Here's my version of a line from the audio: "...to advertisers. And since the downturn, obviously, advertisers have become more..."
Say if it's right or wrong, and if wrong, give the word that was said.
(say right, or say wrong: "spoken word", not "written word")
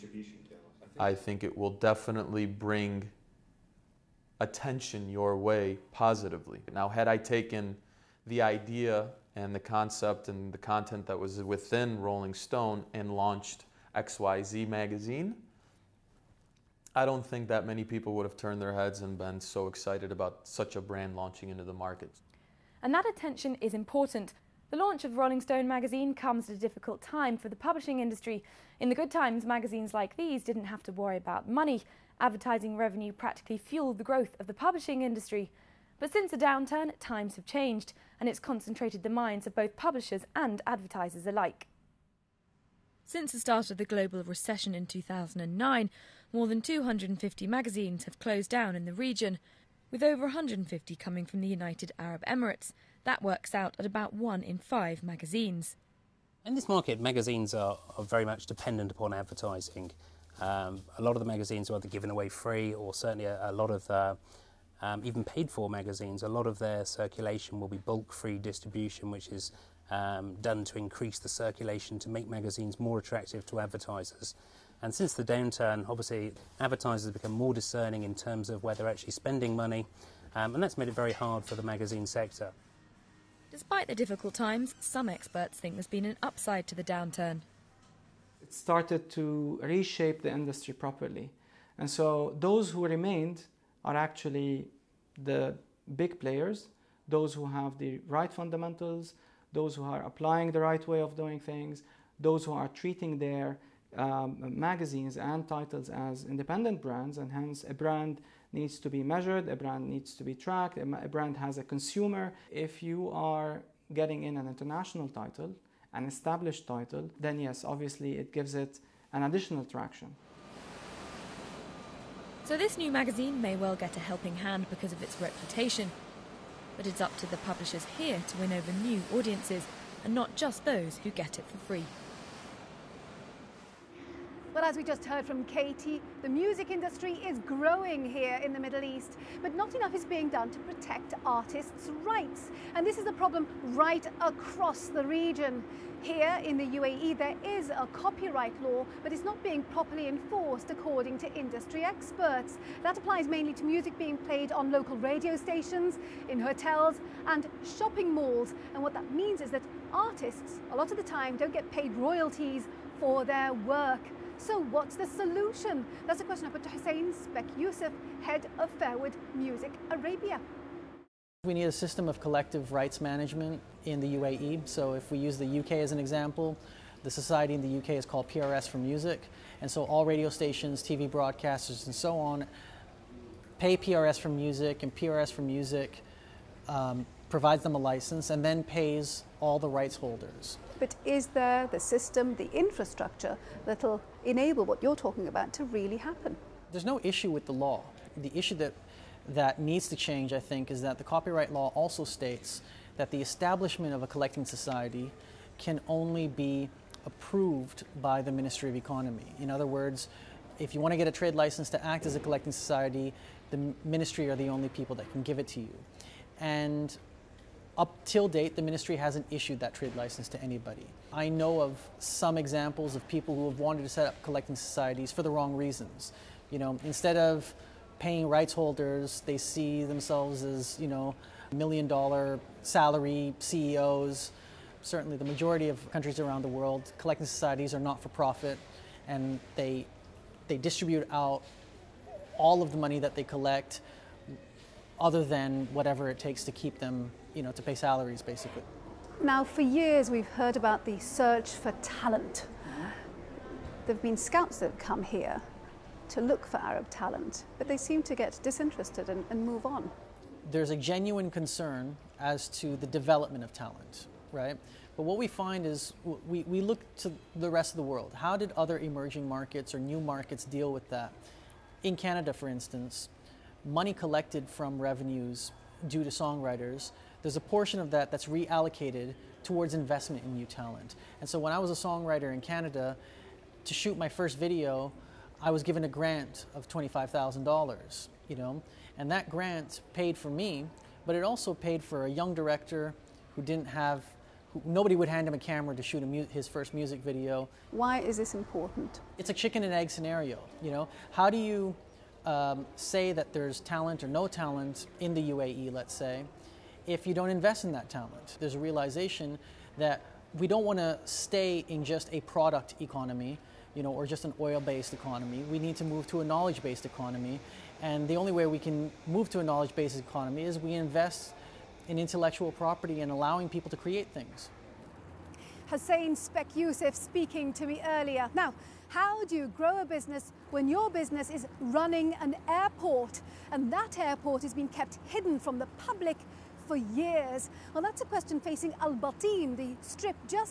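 right.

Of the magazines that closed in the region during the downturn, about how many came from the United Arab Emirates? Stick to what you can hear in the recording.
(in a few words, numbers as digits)
150.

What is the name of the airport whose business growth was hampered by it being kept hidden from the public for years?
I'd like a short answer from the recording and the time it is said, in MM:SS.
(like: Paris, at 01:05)
Al Bateen, at 05:38.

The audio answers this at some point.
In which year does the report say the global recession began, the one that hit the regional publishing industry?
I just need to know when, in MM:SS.
00:44.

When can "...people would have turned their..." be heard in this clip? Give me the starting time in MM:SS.
00:17.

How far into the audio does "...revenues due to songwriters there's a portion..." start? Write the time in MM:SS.
04:34.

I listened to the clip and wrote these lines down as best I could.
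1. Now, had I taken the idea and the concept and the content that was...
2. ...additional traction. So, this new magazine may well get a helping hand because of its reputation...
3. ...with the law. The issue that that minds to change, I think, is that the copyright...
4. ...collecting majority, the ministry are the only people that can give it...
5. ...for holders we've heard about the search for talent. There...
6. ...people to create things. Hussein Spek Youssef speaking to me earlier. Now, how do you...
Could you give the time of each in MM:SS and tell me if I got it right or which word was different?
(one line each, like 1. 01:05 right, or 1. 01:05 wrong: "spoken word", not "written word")
1. 00:06 right
2. 01:59 right
3. 03:17 wrong: "needs", not "minds"
4. 03:32 wrong: "society", not "majority"
5. 04:09 wrong: "years", not "holders"
6. 05:23 right.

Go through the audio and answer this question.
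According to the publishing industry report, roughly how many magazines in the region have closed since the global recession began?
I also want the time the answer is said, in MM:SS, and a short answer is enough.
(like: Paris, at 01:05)
250, at 00:46.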